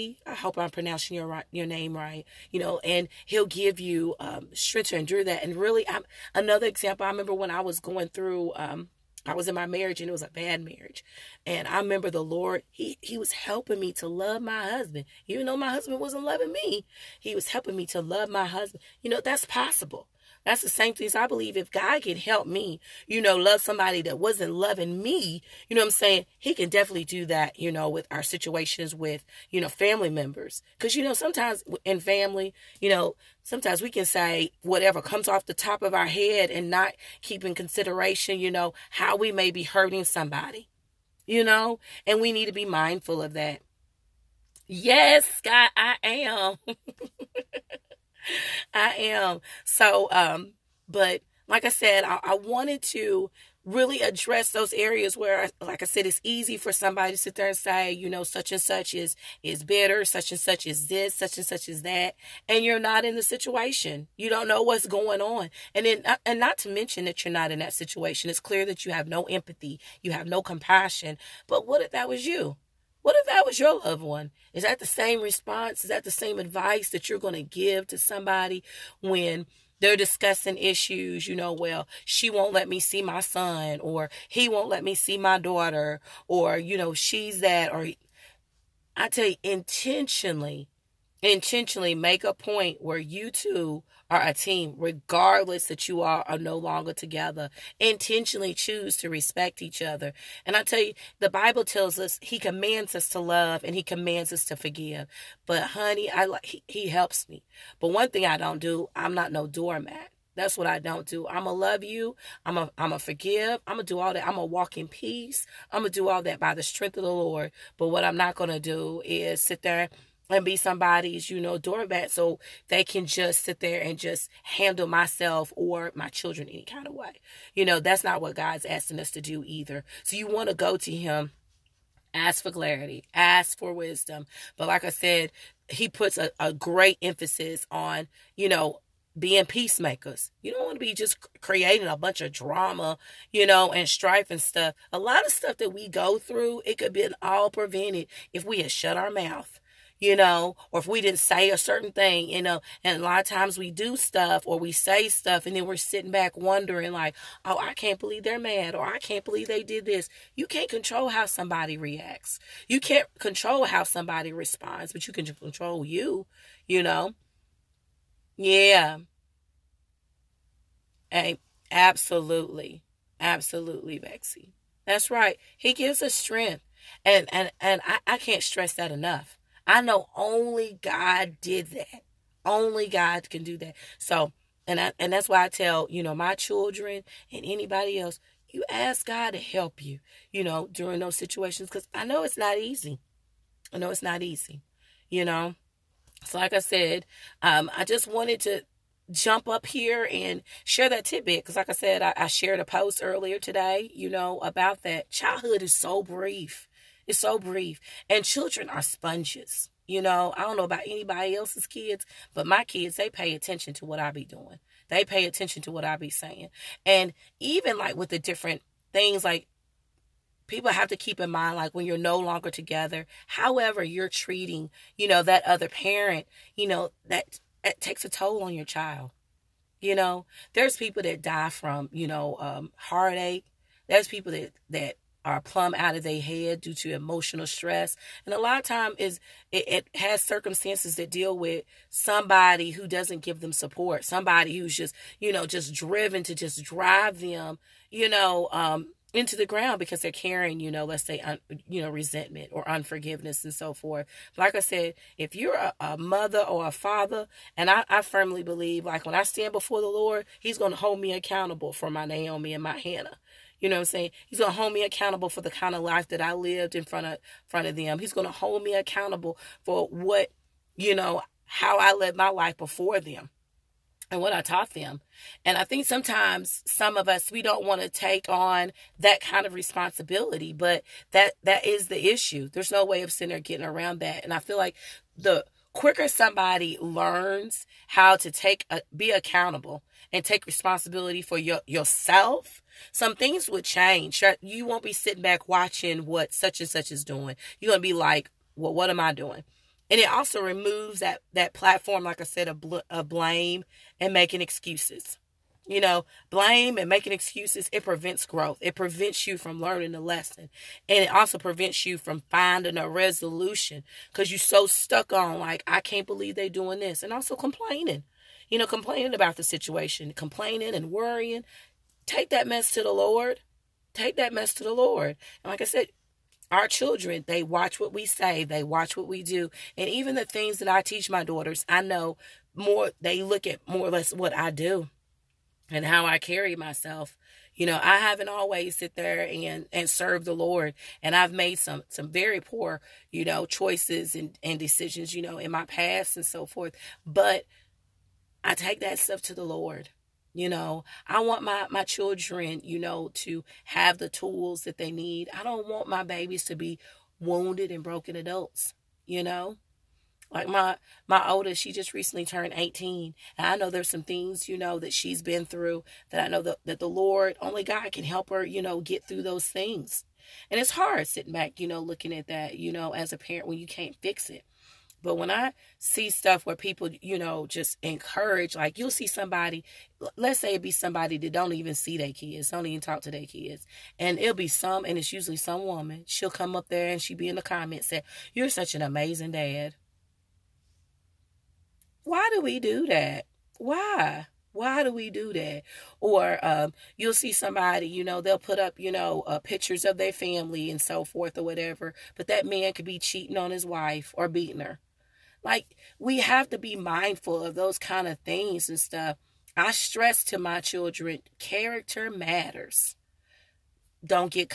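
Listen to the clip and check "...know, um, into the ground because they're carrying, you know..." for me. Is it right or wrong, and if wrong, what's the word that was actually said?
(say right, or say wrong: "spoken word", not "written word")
right.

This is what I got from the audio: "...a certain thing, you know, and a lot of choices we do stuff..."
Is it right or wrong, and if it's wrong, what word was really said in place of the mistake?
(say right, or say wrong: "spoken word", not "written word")
wrong: "times", not "choices".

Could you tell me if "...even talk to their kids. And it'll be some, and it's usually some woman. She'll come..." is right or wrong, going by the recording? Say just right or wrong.
right.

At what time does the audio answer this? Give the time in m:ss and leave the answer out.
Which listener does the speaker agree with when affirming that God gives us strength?
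2:53.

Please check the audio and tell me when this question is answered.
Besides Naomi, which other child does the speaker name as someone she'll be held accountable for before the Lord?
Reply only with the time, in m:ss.
4:22.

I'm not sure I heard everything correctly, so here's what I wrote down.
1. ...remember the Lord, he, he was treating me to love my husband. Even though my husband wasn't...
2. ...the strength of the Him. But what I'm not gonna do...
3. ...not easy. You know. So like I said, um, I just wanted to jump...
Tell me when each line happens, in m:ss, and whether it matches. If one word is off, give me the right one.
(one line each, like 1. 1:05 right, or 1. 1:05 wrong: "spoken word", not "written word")
1. 0:11 wrong: "helping", not "treating"
2. 1:56 wrong: "Lord", not "Him"
3. 3:14 right.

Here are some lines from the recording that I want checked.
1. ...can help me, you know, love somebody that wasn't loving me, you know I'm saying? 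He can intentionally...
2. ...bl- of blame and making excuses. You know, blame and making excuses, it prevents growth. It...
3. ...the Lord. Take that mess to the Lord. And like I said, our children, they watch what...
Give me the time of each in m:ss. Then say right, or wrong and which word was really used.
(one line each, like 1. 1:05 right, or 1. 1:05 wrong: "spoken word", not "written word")
1. 0:22 wrong: "definitely", not "intentionally"
2. 5:02 right
3. 5:22 right.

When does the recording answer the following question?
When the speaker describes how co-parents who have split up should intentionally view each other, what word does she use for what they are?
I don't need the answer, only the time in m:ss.
1:34.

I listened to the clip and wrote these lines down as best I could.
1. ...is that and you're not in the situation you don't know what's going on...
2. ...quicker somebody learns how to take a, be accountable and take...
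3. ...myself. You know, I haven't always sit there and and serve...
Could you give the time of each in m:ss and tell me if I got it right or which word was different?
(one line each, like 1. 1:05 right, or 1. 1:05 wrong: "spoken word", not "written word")
1. 1:01 right
2. 4:45 right
3. 5:36 right.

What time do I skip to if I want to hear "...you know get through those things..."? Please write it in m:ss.
6:08.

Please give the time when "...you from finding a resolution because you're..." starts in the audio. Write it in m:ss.
5:11.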